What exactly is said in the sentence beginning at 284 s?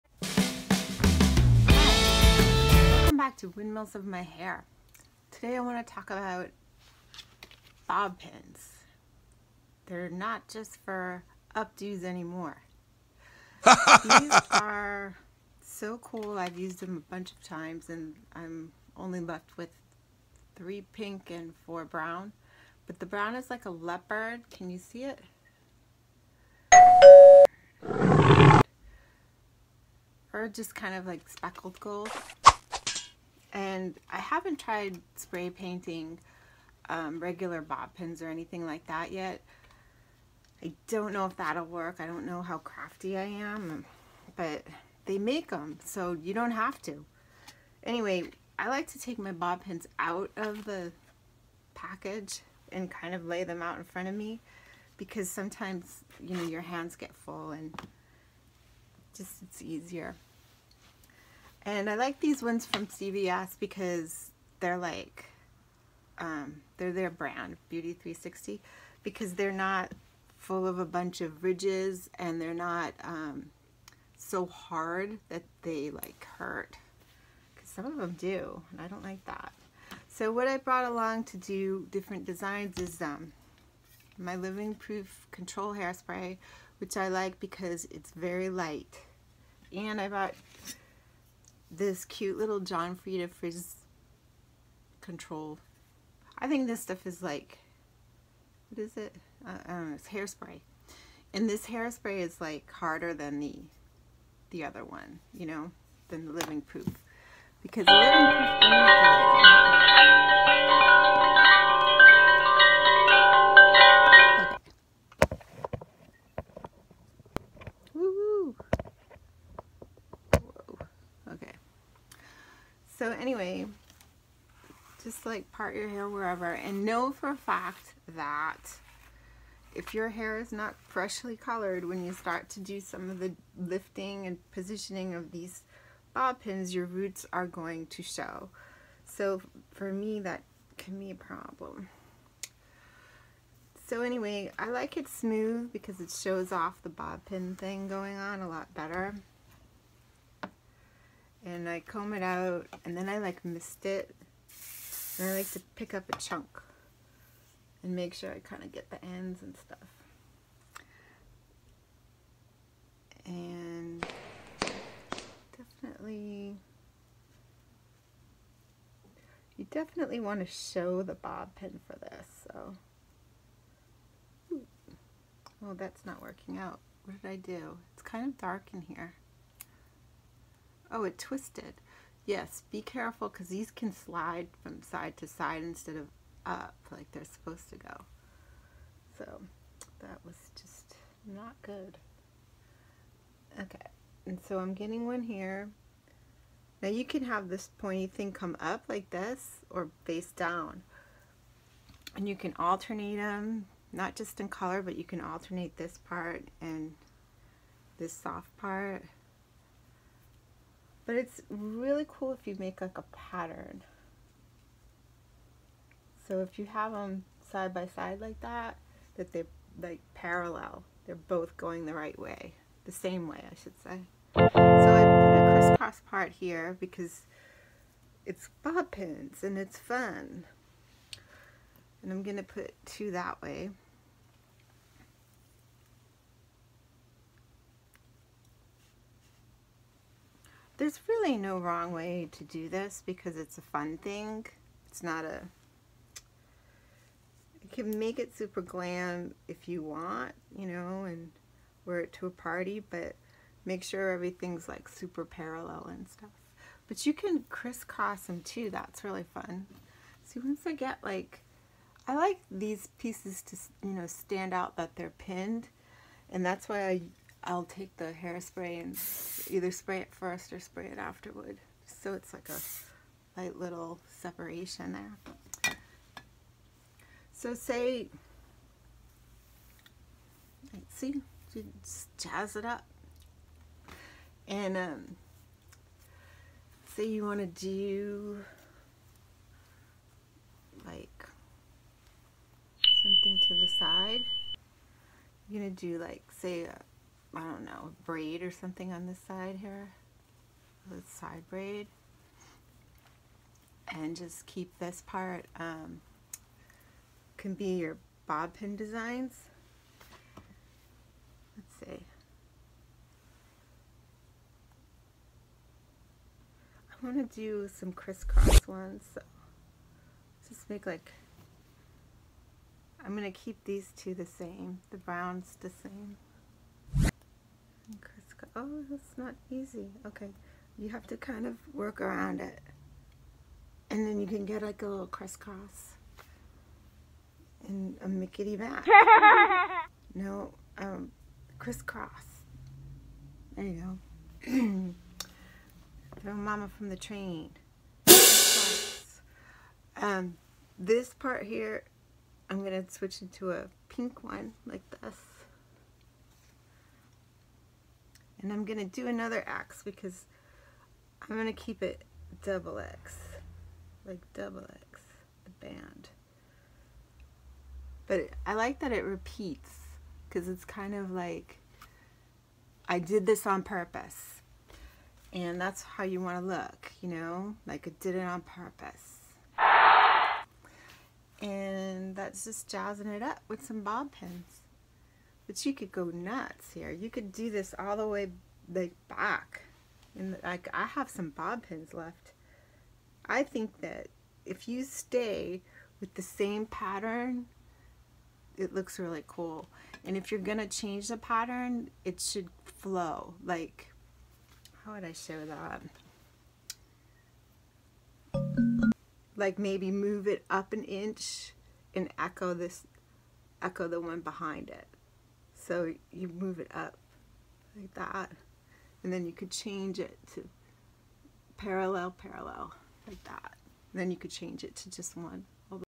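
And um, say you want to do like something to the side.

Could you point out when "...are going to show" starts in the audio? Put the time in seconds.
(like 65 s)
137 s.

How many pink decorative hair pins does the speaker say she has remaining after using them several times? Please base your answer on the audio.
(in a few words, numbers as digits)
3.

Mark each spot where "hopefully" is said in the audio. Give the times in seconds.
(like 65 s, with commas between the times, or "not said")
not said.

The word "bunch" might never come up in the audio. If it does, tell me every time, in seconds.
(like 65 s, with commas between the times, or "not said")
17 s, 70 s.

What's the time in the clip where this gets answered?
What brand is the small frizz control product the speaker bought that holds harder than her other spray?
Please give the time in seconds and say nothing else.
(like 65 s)
92 s.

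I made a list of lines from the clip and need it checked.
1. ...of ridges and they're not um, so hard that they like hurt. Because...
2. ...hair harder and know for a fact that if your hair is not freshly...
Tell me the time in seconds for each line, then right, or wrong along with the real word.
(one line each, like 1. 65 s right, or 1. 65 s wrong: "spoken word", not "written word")
1. 71 s right
2. 125 s wrong: "wherever", not "harder".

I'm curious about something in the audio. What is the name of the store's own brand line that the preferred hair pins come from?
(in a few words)
Beauty 360.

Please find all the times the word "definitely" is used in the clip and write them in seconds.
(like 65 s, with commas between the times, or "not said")
165 s, 169 s.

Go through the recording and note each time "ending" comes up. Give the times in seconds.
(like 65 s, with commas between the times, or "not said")
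not said.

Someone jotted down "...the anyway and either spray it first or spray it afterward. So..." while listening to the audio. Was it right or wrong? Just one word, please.
wrong.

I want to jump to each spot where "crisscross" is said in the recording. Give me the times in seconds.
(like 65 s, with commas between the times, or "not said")
225 s, 257 s, 317 s, 335 s, 341 s.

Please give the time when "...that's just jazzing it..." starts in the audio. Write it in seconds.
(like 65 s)
382 s.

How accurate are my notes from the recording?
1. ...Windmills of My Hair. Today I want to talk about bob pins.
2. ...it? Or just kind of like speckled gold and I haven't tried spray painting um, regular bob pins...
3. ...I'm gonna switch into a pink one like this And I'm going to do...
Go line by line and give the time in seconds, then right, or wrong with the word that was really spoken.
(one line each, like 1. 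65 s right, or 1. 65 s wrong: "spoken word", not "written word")
1. 3 s right
2. 25 s right
3. 352 s right.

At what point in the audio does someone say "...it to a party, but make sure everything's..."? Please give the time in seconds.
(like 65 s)
251 s.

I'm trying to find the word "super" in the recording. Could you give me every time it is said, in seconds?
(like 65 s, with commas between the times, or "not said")
248 s, 254 s.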